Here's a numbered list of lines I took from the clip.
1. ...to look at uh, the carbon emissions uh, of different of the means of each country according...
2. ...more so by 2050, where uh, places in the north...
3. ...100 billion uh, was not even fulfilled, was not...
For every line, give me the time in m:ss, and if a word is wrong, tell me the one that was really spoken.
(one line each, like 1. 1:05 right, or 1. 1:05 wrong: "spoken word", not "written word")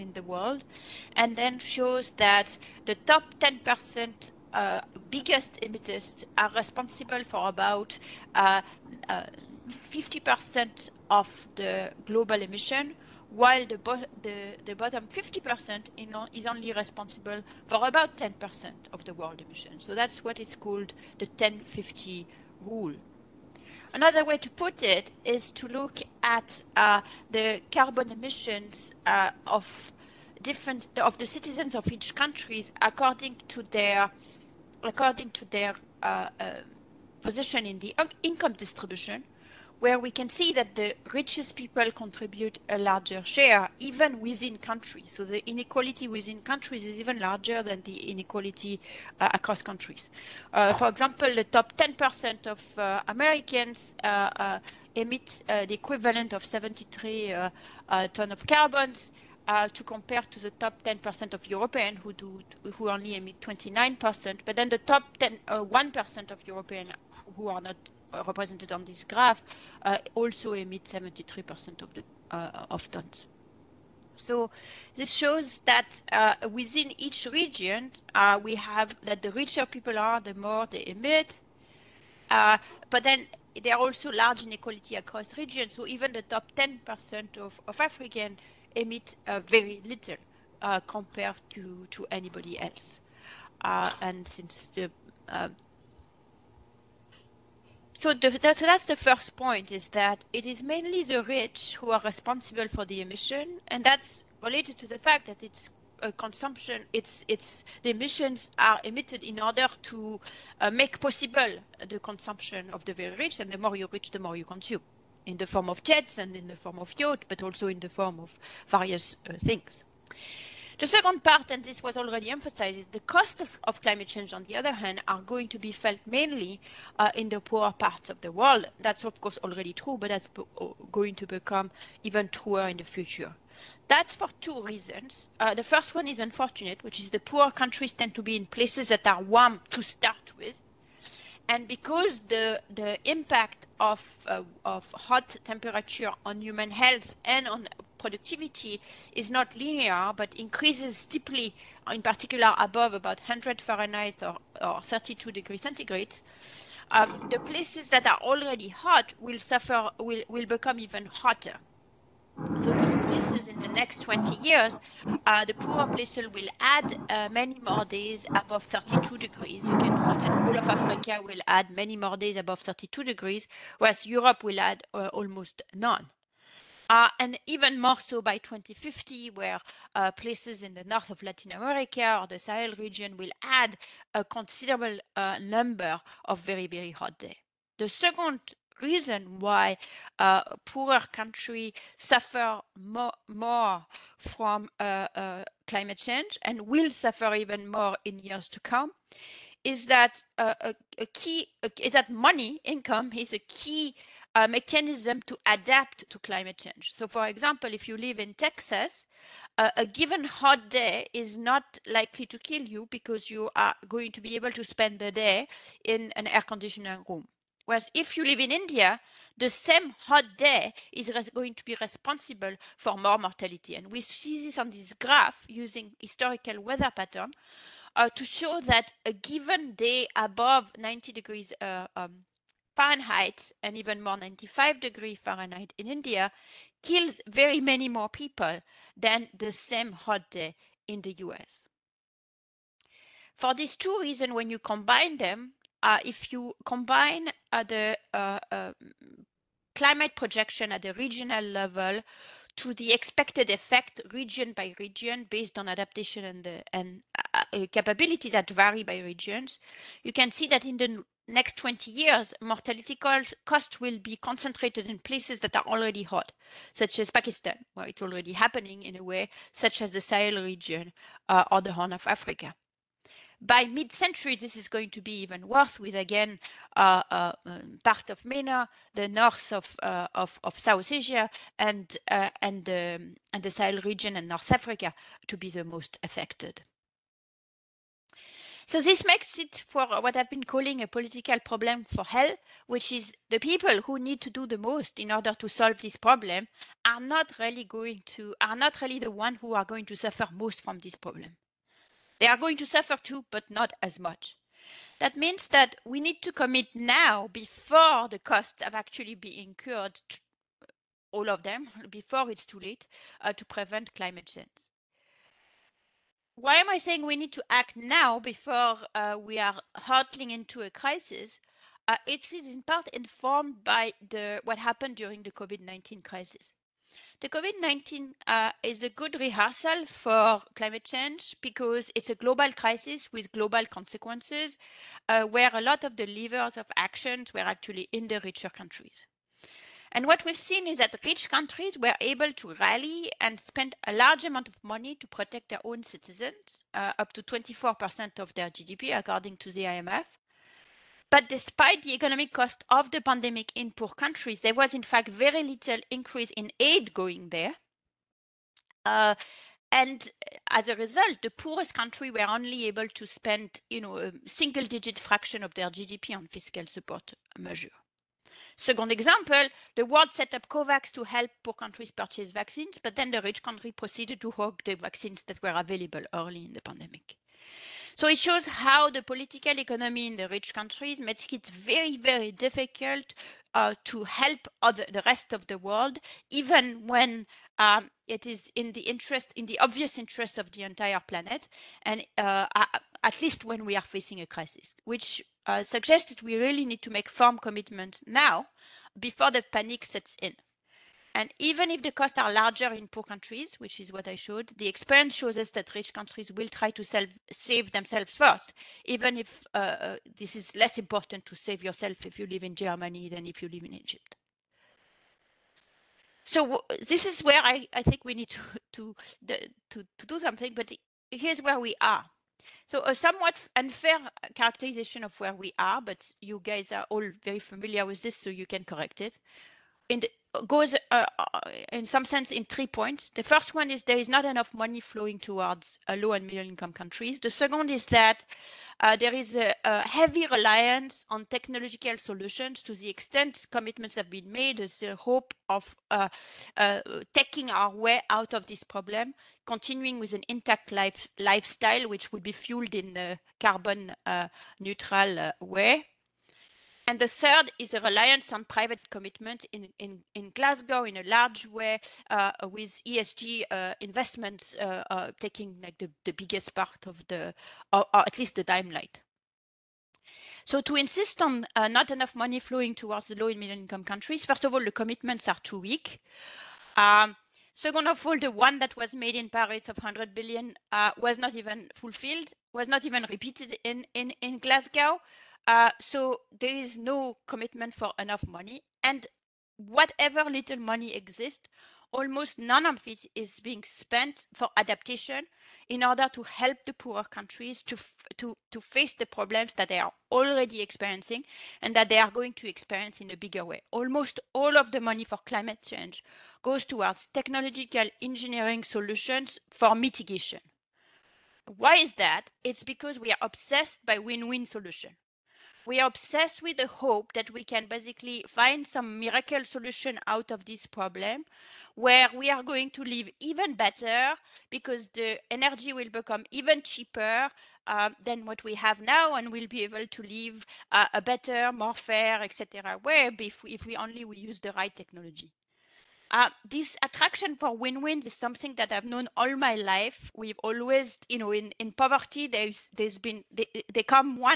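1. 0:25 wrong: "citizens", not "means"
2. 2:57 right
3. 7:59 right.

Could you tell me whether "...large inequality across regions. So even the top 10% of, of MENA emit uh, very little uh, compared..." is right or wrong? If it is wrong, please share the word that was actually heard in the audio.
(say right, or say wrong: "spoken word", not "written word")
wrong: "African", not "MENA".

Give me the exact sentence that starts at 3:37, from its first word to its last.
Whereas if you live in India, the same hot day is going to be responsible for more mortality.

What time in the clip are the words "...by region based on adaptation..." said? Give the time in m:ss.
4:14.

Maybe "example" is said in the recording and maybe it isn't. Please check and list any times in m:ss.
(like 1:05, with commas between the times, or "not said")
0:50, 3:27, 6:08.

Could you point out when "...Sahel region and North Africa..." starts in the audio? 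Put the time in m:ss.
4:43.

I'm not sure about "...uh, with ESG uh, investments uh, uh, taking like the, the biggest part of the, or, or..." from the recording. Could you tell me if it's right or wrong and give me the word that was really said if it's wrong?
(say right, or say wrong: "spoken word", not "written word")
right.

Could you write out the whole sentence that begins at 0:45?
So the inequality within countries is even larger than the inequality uh, across countries.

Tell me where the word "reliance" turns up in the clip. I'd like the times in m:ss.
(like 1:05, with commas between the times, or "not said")
7:20, 7:37.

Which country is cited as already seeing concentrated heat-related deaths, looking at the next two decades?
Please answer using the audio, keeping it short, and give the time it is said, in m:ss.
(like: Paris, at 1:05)
Pakistan, at 4:27.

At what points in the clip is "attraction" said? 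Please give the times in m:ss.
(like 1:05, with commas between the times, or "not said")
8:56.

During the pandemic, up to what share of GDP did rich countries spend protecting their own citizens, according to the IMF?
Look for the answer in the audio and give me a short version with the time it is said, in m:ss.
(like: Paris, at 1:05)
24%, at 5:47.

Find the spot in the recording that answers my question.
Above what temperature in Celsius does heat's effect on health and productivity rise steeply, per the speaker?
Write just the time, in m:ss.
2:34.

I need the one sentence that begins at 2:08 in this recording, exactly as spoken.
That's, of course, already true, but that's uh, going to become even truer in the future.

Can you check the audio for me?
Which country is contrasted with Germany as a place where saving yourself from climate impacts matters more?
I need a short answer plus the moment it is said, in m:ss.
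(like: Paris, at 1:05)
Egypt, at 6:53.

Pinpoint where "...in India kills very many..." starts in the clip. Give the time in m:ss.
3:55.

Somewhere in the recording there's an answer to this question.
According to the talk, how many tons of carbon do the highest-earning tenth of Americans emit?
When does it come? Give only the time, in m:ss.
0:56.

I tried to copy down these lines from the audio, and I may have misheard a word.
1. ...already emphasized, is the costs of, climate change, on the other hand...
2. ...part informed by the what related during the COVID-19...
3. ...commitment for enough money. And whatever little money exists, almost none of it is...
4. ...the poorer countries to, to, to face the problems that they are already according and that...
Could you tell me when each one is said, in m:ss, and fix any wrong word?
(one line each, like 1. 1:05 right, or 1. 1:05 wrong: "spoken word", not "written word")
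1. 2:01 right
2. 5:22 wrong: "happened", not "related"
3. 8:07 right
4. 8:16 wrong: "experiencing", not "according".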